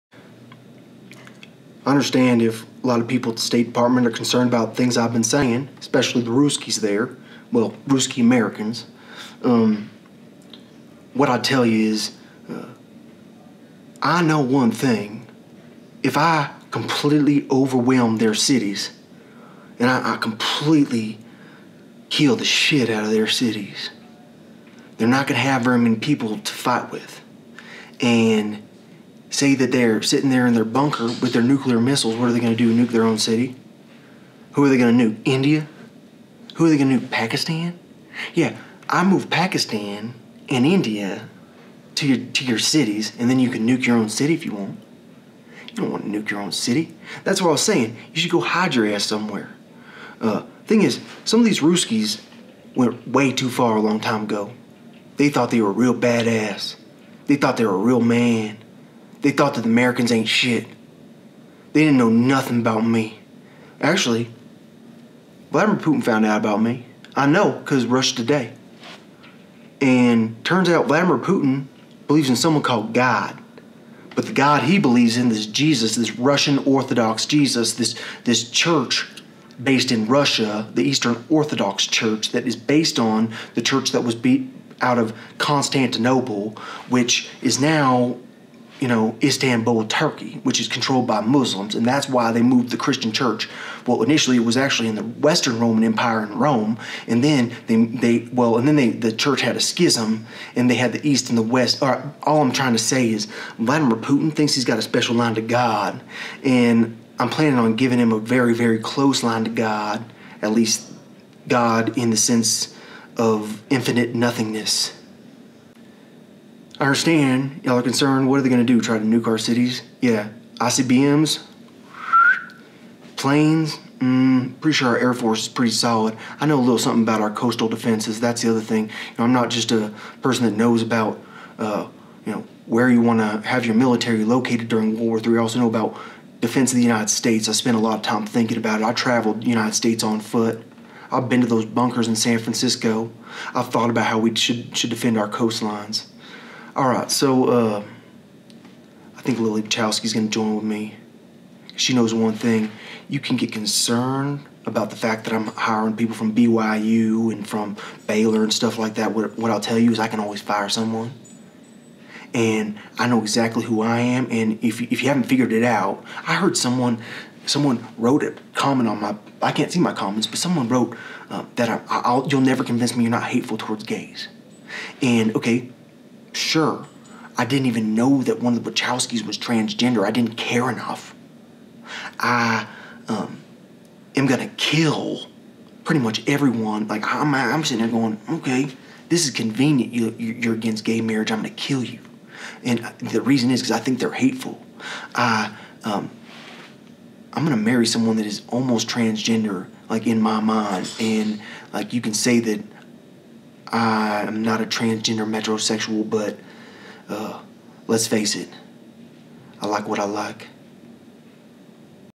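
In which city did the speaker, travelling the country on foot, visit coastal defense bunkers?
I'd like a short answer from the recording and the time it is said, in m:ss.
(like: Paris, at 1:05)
San Francisco, at 2:22.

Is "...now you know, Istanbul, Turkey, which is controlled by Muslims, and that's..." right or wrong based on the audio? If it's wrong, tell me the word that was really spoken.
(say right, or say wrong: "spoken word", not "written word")
right.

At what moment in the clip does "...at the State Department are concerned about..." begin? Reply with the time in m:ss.
0:03.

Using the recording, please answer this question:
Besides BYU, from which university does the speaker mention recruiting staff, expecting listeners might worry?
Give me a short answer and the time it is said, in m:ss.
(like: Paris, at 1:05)
Baylor, at 2:38.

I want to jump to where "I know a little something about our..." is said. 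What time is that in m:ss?
2:06.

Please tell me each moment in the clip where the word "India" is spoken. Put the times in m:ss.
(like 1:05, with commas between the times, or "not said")
0:35, 0:40.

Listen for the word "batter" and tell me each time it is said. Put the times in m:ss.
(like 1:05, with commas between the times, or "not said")
not said.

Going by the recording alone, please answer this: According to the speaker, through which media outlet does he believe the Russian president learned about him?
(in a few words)
Russia Today.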